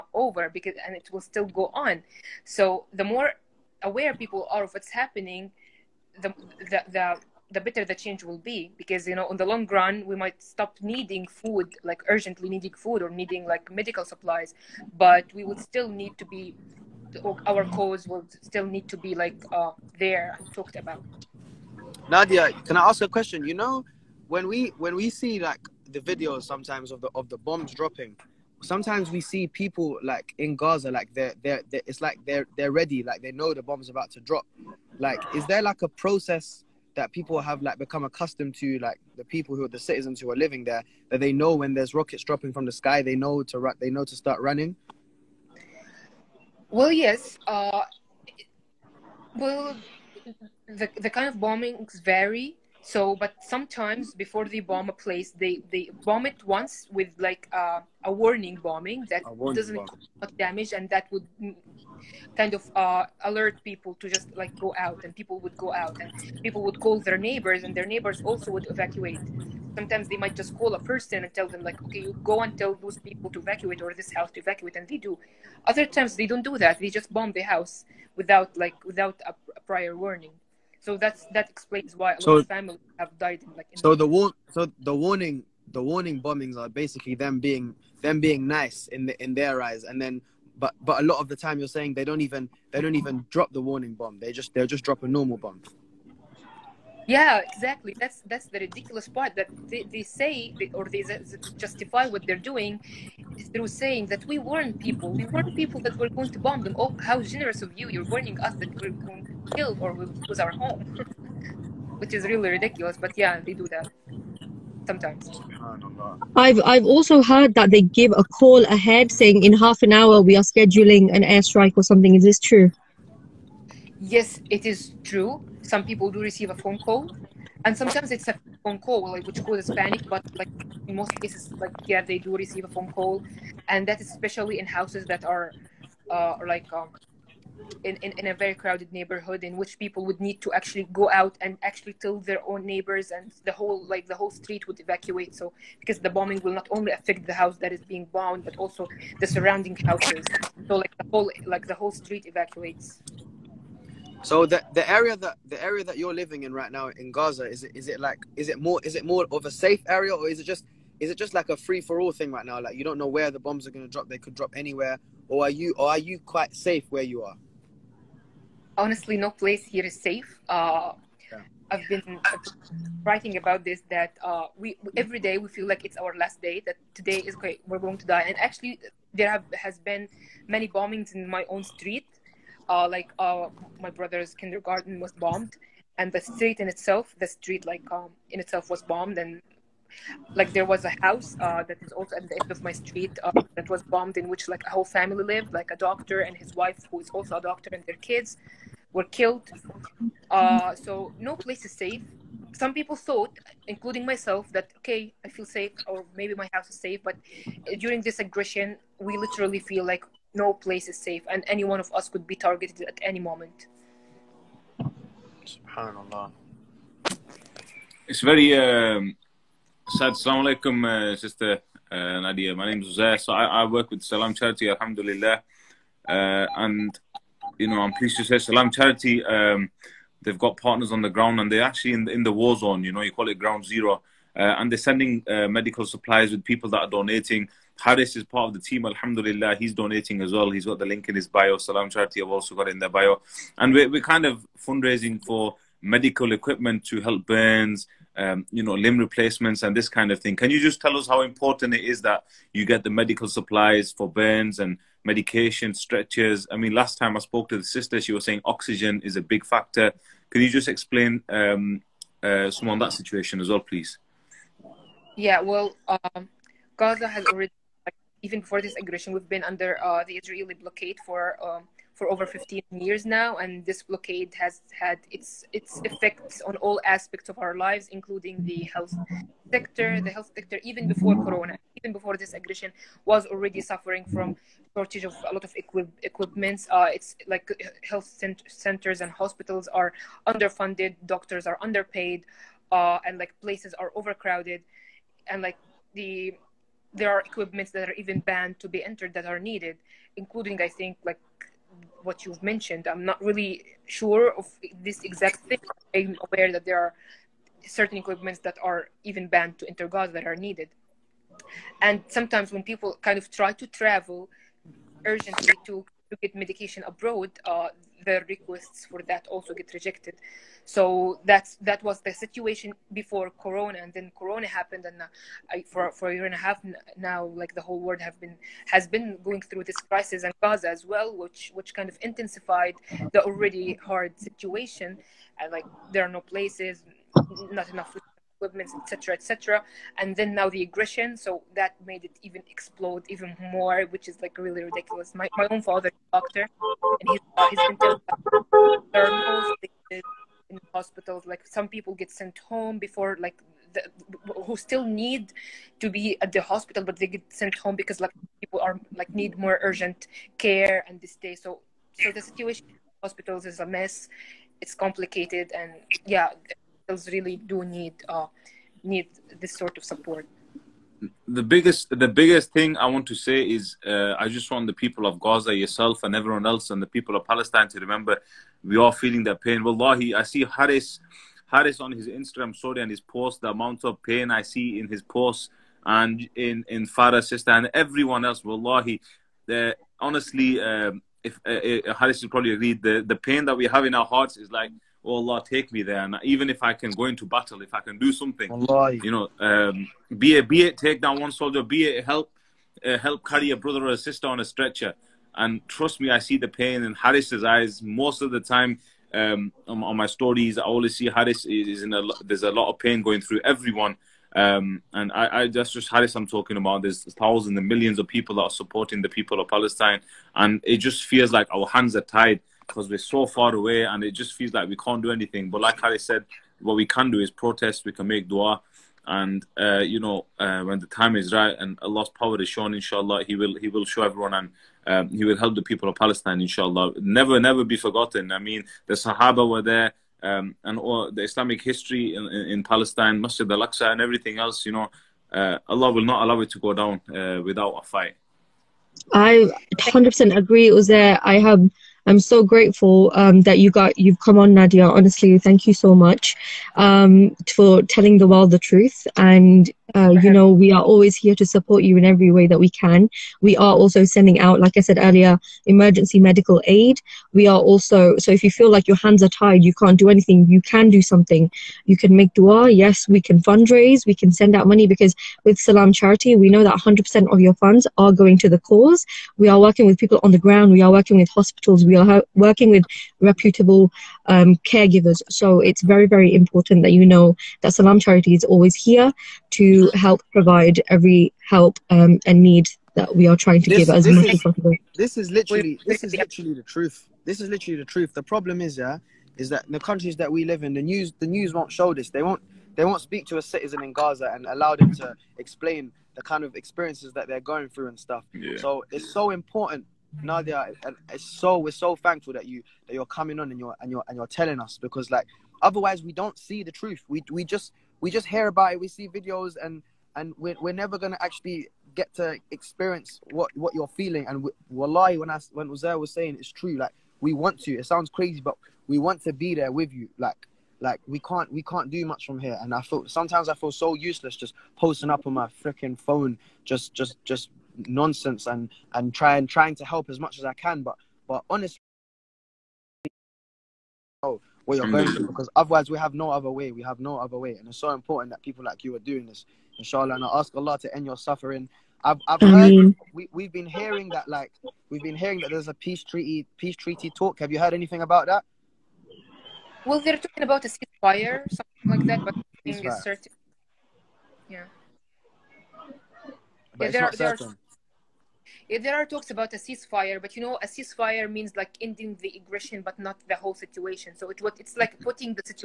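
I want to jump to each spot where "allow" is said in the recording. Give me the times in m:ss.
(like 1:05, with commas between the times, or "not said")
7:26, 8:24.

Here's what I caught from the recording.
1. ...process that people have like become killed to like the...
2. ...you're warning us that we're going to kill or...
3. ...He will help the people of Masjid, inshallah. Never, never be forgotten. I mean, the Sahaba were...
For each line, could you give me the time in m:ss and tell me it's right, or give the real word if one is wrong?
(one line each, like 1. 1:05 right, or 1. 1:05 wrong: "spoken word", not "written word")
1. 0:35 wrong: "accustomed", not "killed"
2. 1:47 right
3. 7:15 wrong: "Palestine", not "Masjid".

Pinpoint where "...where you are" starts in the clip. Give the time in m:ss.
2:46.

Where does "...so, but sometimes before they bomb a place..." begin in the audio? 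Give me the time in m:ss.
0:52.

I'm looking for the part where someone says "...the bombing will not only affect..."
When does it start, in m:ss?
2:25.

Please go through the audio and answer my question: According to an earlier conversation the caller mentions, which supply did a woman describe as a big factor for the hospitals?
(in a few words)
oxygen.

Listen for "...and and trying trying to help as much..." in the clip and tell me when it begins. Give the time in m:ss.
8:58.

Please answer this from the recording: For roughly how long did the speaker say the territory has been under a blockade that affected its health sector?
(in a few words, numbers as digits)
over 15 years.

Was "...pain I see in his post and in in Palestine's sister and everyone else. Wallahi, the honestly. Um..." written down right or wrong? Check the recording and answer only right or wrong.
wrong.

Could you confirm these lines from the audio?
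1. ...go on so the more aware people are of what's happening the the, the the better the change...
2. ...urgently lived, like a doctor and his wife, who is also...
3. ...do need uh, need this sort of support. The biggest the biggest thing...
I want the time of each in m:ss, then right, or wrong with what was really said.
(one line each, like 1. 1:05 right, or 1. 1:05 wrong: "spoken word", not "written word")
1. 0:01 right
2. 3:14 wrong: "family", not "urgently"
3. 6:07 right.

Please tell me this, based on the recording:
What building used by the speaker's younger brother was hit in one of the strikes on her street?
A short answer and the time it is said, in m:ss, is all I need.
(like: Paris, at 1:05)
kindergarten, at 3:04.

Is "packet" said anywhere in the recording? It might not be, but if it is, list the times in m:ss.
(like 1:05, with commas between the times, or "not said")
not said.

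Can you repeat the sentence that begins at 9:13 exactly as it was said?
we, we've been hearing that like we've been hearing that there's a peace treaty peace treaty talk.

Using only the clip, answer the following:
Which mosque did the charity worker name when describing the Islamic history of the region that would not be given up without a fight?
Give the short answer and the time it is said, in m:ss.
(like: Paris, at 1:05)
Masjid Al-Aqsa, at 7:23.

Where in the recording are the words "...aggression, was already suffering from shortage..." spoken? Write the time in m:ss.
4:42.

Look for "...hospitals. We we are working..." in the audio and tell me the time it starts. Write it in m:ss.
8:01.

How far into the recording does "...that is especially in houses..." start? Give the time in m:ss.
2:13.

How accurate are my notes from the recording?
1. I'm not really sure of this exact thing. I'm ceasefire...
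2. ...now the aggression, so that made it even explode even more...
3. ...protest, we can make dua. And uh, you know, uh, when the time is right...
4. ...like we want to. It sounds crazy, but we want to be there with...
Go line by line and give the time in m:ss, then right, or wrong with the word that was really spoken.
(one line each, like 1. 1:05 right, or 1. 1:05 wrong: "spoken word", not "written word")
1. 5:02 wrong: "aware", not "ceasefire"
2. 5:40 right
3. 7:07 right
4. 8:46 right.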